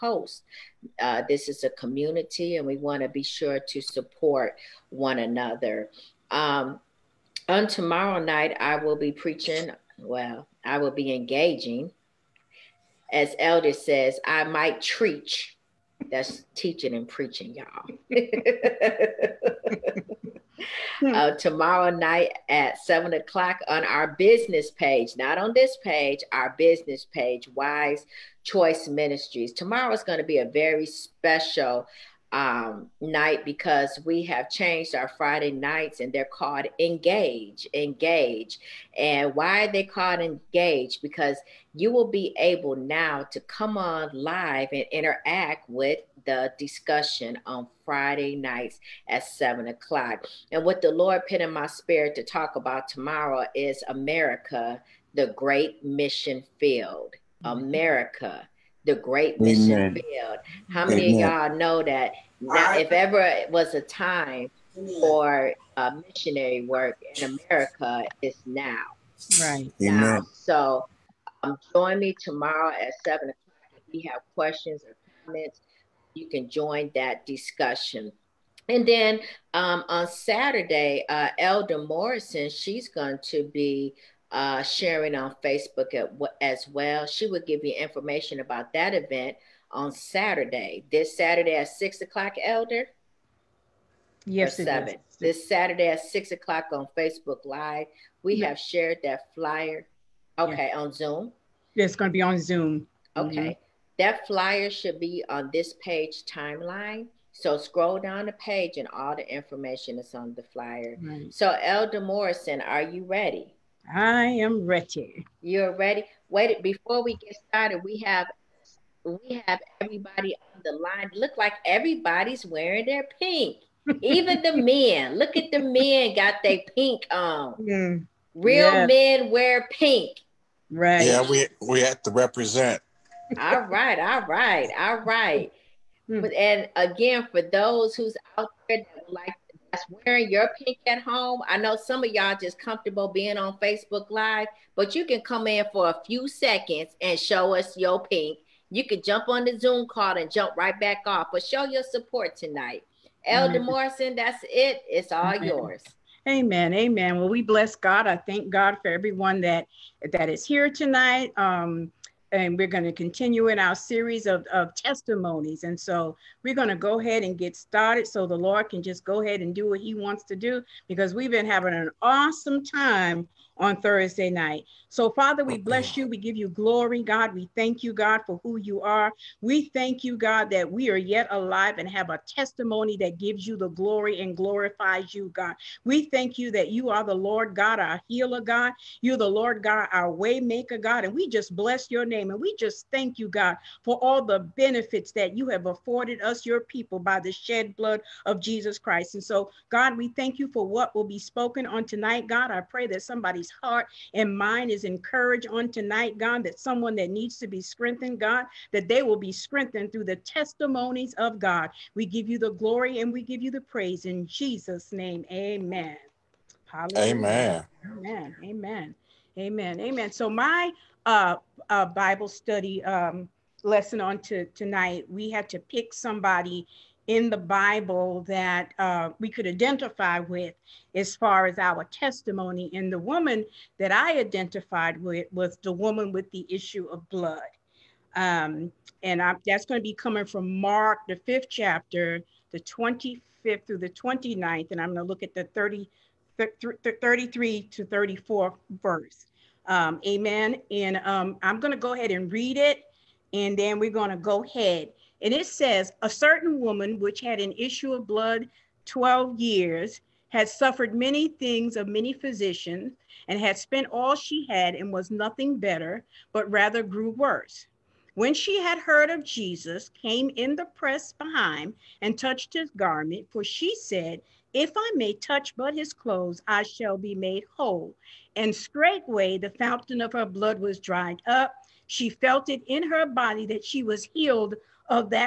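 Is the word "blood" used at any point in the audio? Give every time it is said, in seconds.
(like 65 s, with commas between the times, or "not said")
197 s, 237 s, 258 s, 280 s.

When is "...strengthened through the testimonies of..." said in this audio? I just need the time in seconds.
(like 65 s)
209 s.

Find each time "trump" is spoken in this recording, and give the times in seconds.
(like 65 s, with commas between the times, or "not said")
not said.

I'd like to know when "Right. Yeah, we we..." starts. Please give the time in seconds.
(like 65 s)
130 s.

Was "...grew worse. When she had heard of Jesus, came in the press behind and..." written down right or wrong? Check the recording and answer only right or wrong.
right.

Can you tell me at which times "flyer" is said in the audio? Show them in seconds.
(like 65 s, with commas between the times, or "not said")
99 s, 104 s, 110 s.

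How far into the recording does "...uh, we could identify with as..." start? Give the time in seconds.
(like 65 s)
228 s.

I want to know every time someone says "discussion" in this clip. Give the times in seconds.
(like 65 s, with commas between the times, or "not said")
46 s, 77 s.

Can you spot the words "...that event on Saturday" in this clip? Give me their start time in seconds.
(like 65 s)
88 s.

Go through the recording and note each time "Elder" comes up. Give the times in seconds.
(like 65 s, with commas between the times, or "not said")
13 s, 81 s, 92 s, 111 s, 153 s.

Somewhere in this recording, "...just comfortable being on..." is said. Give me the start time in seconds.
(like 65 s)
142 s.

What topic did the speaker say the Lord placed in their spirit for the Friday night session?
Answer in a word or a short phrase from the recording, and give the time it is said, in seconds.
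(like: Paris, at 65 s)
America, the great mission field, at 53 s.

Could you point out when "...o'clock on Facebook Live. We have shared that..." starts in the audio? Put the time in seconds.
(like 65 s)
96 s.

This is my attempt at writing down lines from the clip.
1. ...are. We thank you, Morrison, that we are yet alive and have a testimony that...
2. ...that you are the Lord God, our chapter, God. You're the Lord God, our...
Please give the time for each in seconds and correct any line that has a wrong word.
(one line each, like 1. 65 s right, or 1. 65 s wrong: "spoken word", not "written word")
1. 178 s wrong: "God", not "Morrison"
2. 186 s wrong: "healer", not "chapter".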